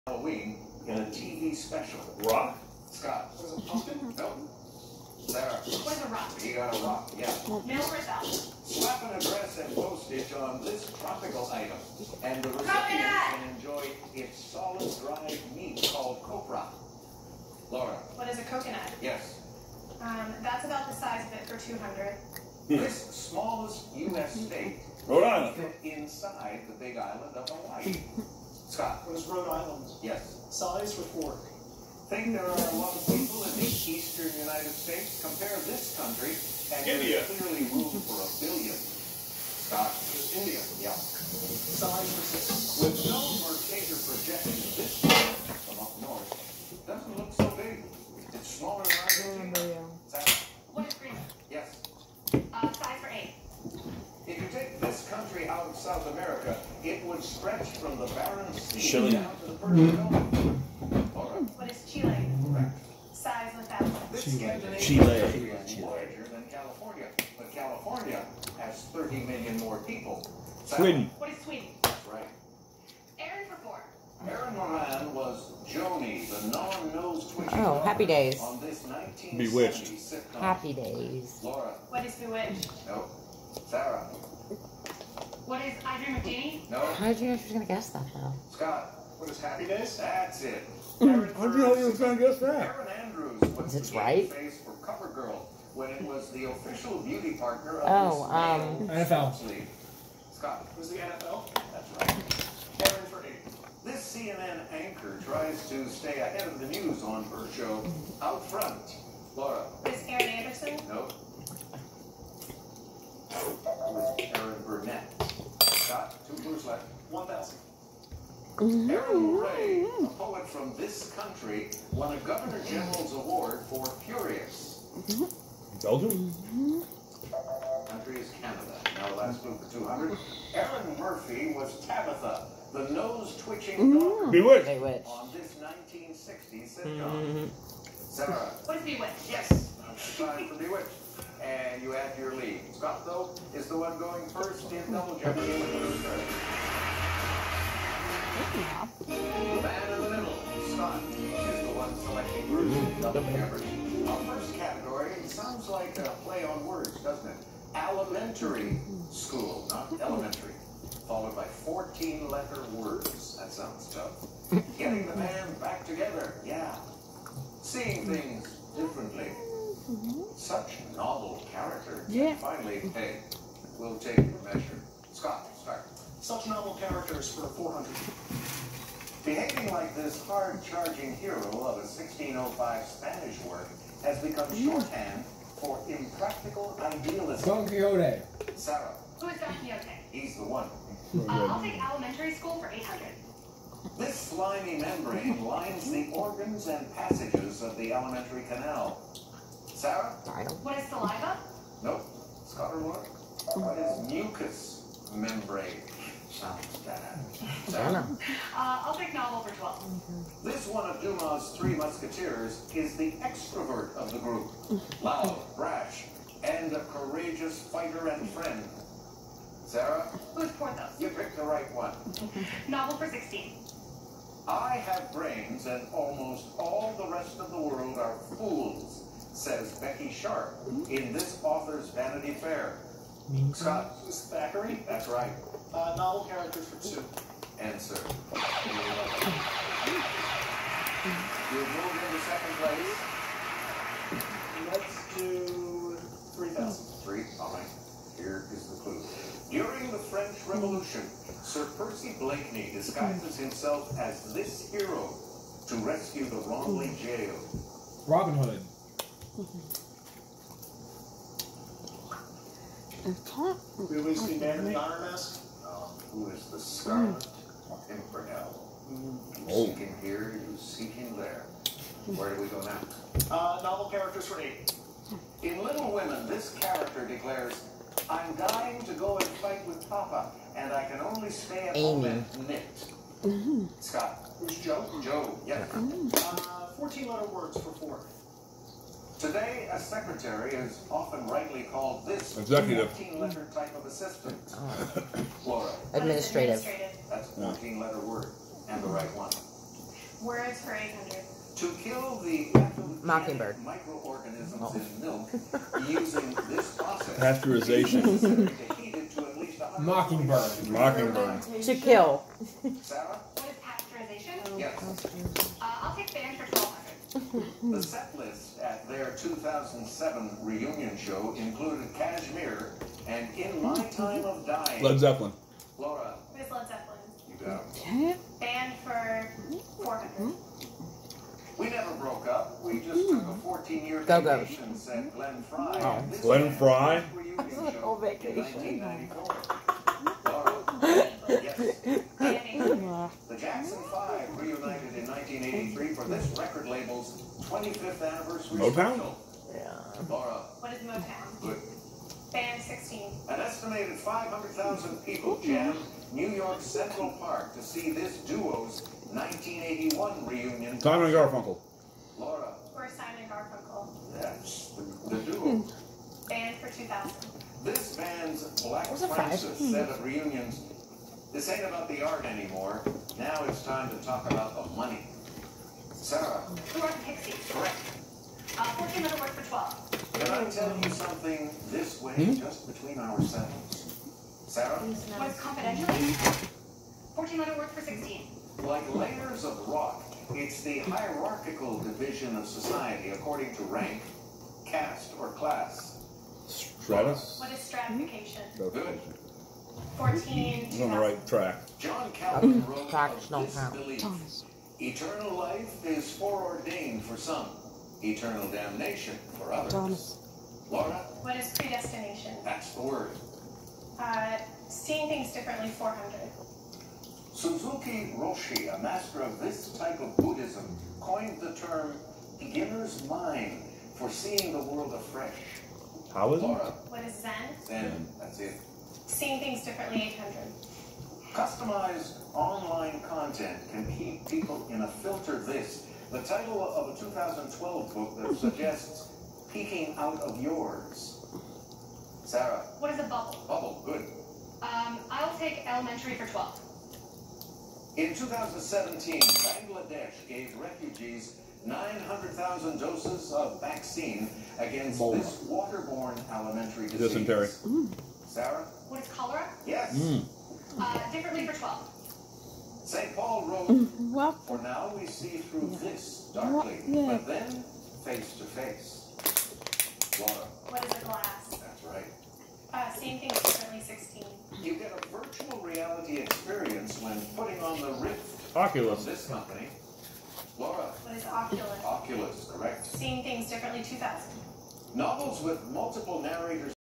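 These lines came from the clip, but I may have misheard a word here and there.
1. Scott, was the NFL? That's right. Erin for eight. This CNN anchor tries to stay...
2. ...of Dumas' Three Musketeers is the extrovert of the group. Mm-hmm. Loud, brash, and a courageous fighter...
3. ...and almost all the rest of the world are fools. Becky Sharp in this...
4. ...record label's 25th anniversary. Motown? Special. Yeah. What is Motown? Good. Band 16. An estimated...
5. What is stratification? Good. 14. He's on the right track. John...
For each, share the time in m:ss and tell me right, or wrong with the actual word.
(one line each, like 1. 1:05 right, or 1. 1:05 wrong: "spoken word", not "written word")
1. 1:40 right
2. 3:30 right
3. 3:45 right
4. 5:46 right
5. 6:37 right.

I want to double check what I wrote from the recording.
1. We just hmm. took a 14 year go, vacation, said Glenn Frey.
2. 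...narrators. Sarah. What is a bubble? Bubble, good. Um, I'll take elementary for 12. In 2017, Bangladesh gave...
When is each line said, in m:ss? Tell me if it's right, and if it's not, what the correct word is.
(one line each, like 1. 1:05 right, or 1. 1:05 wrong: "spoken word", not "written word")
1. 5:32 right
2. 7:20 wrong: "yours", not "narrators".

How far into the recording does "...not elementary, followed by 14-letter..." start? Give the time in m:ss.
2:39.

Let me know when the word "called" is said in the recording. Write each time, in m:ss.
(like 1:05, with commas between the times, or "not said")
0:15, 4:51.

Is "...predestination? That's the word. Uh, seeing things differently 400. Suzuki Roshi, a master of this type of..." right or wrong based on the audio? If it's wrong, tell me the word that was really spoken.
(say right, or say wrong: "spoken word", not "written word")
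right.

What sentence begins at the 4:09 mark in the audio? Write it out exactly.
During the French Revolution, Sir Percy Blakeney disguises himself as this hero to rescue the wrongly jail.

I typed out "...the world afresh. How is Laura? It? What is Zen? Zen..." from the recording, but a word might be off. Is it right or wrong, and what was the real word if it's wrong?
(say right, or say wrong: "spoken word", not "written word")
right.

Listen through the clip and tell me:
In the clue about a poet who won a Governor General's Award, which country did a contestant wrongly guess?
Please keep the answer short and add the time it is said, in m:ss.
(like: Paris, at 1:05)
Belgium, at 2:05.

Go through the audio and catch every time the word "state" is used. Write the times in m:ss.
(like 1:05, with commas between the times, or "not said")
0:24, 0:34.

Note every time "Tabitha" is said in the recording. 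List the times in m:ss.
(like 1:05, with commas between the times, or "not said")
2:11.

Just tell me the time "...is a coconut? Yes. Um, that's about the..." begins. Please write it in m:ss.
0:18.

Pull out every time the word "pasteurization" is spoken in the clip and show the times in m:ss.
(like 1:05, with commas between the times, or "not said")
5:07, 5:13.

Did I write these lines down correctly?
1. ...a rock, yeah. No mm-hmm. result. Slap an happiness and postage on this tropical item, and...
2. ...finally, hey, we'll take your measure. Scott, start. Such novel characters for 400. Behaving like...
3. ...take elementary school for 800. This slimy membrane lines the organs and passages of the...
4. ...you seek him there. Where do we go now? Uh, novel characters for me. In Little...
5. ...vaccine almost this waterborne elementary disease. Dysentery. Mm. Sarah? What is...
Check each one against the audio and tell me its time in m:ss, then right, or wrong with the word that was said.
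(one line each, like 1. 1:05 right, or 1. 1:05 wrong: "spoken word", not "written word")
1. 0:06 wrong: "address", not "happiness"
2. 2:52 right
3. 3:11 right
4. 4:30 right
5. 7:33 wrong: "against", not "almost".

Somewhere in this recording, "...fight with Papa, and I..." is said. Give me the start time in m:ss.
4:39.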